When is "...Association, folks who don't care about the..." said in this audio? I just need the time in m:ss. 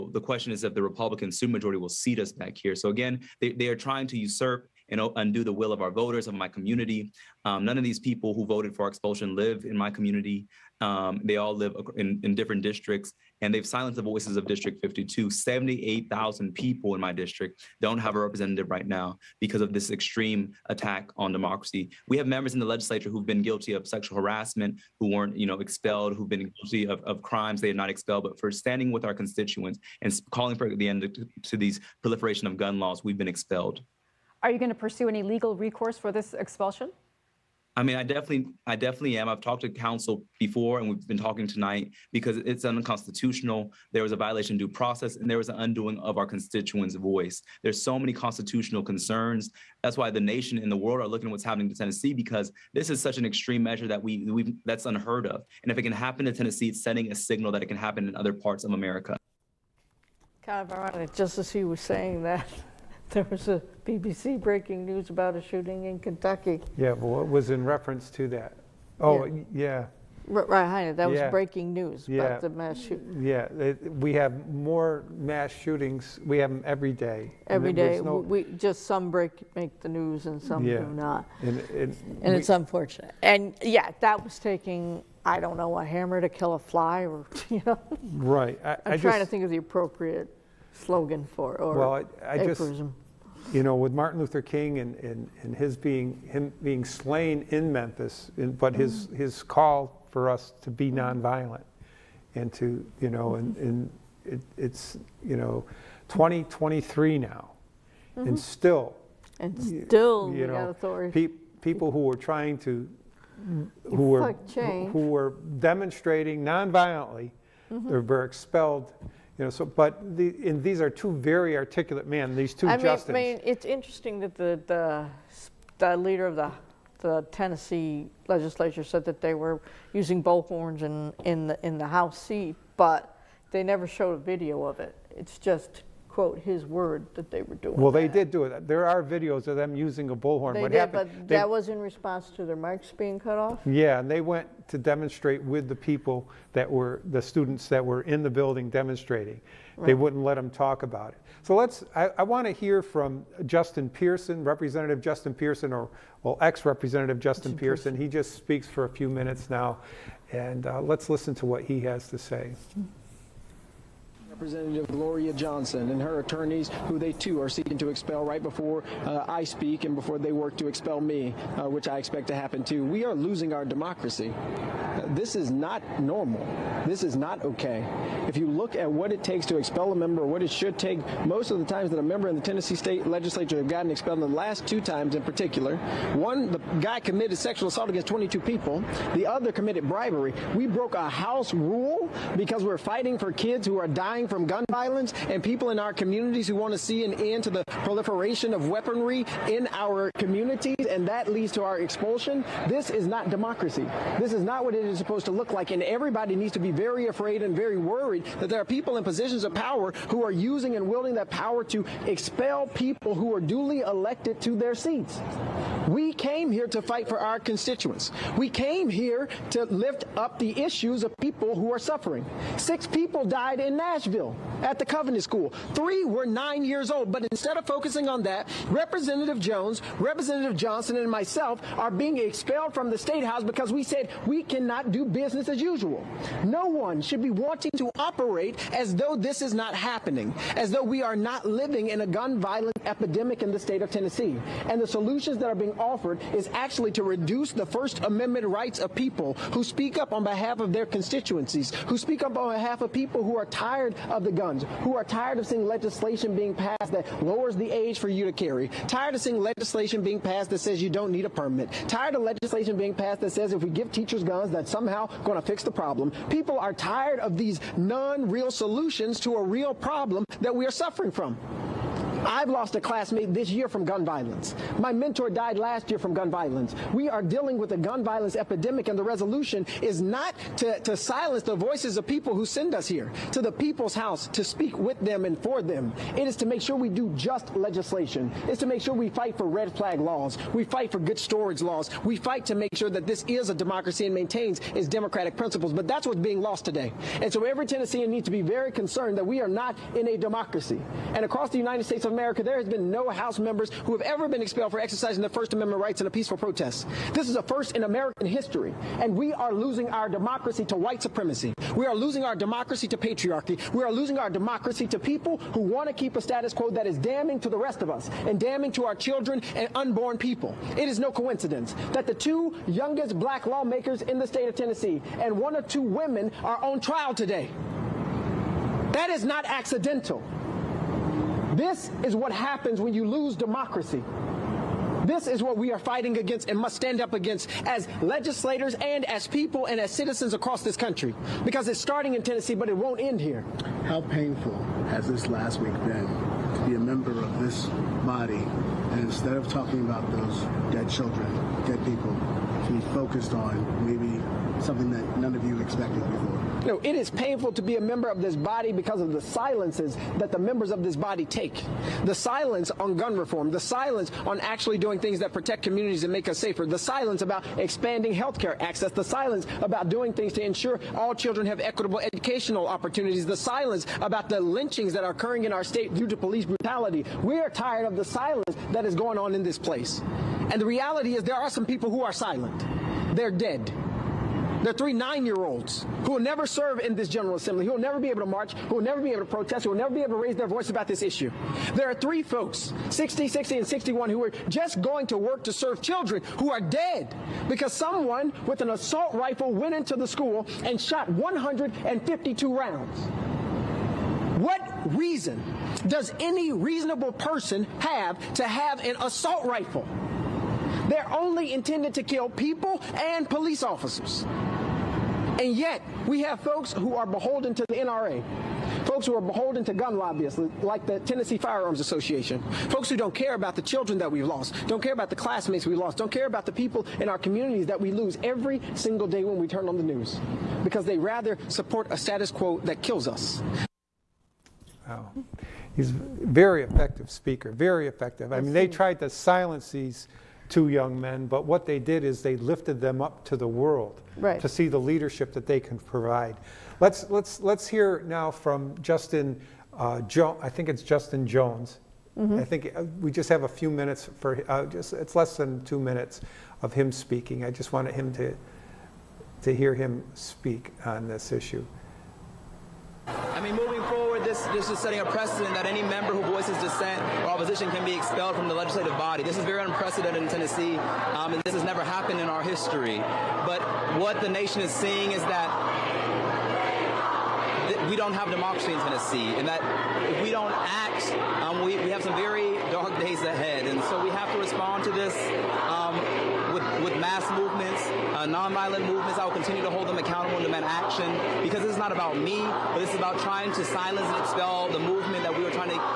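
7:01.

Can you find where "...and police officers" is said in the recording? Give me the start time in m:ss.
6:52.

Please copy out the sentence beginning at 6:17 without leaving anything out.
We are tired of the silence that is going on in this place.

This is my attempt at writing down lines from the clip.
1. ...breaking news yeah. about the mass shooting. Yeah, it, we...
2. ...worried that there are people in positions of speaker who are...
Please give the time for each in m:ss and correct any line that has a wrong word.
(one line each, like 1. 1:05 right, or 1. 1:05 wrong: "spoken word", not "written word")
1. 1:11 right
2. 3:27 wrong: "power", not "speaker".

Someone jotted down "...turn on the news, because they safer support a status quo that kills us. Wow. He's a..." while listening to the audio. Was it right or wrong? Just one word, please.
wrong.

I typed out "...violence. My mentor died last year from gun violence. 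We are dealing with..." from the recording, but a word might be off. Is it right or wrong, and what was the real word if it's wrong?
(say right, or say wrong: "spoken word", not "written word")
right.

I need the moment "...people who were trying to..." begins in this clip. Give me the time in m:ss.
1:51.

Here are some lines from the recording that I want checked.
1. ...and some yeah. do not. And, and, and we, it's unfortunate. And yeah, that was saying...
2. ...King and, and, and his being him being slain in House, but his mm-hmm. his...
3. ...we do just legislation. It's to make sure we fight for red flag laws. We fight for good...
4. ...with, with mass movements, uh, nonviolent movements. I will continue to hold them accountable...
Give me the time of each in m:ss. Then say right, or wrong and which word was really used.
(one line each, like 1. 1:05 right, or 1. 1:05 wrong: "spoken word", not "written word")
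1. 1:20 wrong: "taking", not "saying"
2. 1:34 wrong: "Memphis", not "House"
3. 4:46 right
4. 8:06 right.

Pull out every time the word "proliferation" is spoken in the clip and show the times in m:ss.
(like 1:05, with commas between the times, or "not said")
0:32, 3:17.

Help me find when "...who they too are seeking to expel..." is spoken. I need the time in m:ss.
2:46.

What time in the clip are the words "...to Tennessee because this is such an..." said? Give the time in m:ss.
0:51.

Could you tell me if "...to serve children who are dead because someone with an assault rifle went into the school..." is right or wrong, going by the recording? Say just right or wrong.
right.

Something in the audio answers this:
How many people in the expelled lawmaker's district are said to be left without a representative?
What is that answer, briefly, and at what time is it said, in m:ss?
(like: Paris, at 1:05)
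78,000, at 0:15.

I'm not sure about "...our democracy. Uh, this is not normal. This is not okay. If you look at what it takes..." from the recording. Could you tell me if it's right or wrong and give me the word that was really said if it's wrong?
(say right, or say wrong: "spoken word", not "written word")
right.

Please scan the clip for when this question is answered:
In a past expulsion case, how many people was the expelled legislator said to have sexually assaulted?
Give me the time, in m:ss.
3:08.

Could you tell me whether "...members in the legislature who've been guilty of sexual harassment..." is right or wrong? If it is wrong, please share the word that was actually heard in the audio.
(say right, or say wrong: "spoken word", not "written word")
right.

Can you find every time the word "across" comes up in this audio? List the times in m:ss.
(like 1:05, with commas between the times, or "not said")
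5:01, 5:40.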